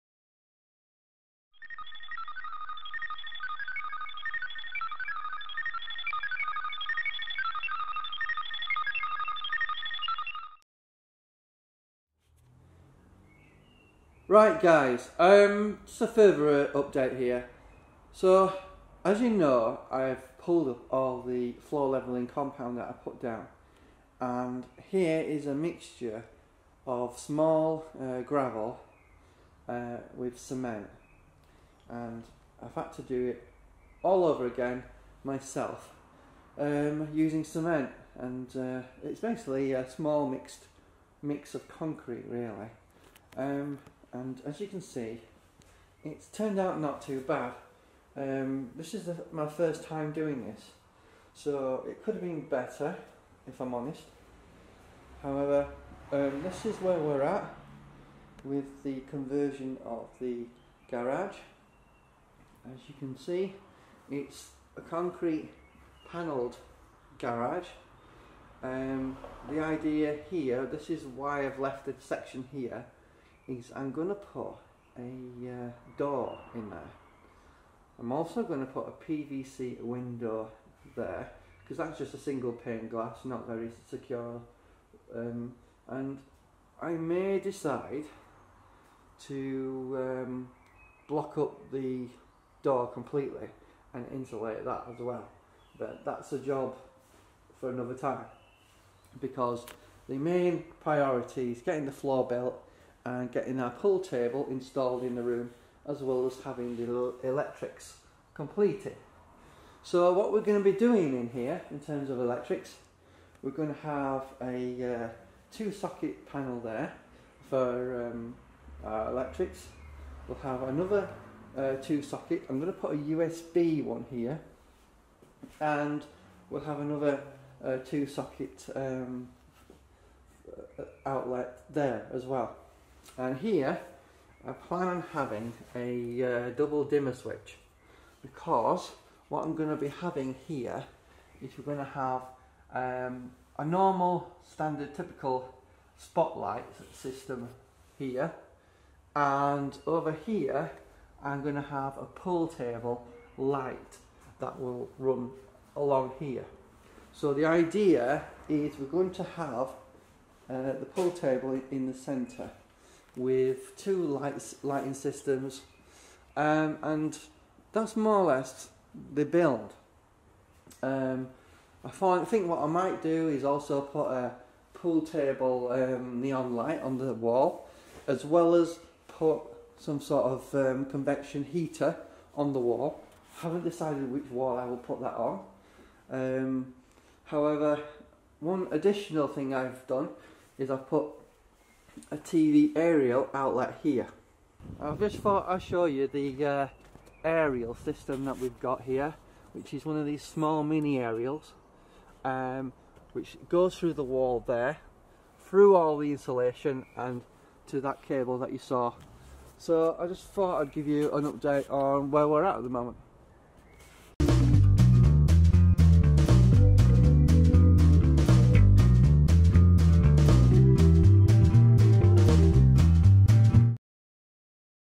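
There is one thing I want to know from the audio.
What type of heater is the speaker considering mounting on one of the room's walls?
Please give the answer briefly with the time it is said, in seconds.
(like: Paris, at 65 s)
convection heater, at 180 s.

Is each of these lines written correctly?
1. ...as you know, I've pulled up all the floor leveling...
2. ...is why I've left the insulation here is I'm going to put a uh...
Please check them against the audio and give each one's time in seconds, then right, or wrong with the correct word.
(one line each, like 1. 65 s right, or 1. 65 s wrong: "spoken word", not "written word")
1. 19 s right
2. 70 s wrong: "section", not "insulation".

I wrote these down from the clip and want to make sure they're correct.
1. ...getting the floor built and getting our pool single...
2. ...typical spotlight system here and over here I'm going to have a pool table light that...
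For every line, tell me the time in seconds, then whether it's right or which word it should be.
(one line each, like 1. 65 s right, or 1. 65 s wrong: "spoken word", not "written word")
1. 101 s wrong: "table", not "single"
2. 144 s right.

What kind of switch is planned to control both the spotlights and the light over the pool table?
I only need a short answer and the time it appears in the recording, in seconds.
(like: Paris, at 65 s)
double dimmer switch, at 136 s.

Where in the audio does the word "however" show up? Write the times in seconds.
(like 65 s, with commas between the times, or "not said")
55 s, 187 s.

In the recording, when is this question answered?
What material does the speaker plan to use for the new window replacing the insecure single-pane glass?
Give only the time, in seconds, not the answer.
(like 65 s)
79 s.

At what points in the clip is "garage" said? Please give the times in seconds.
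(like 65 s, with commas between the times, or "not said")
60 s, 67 s.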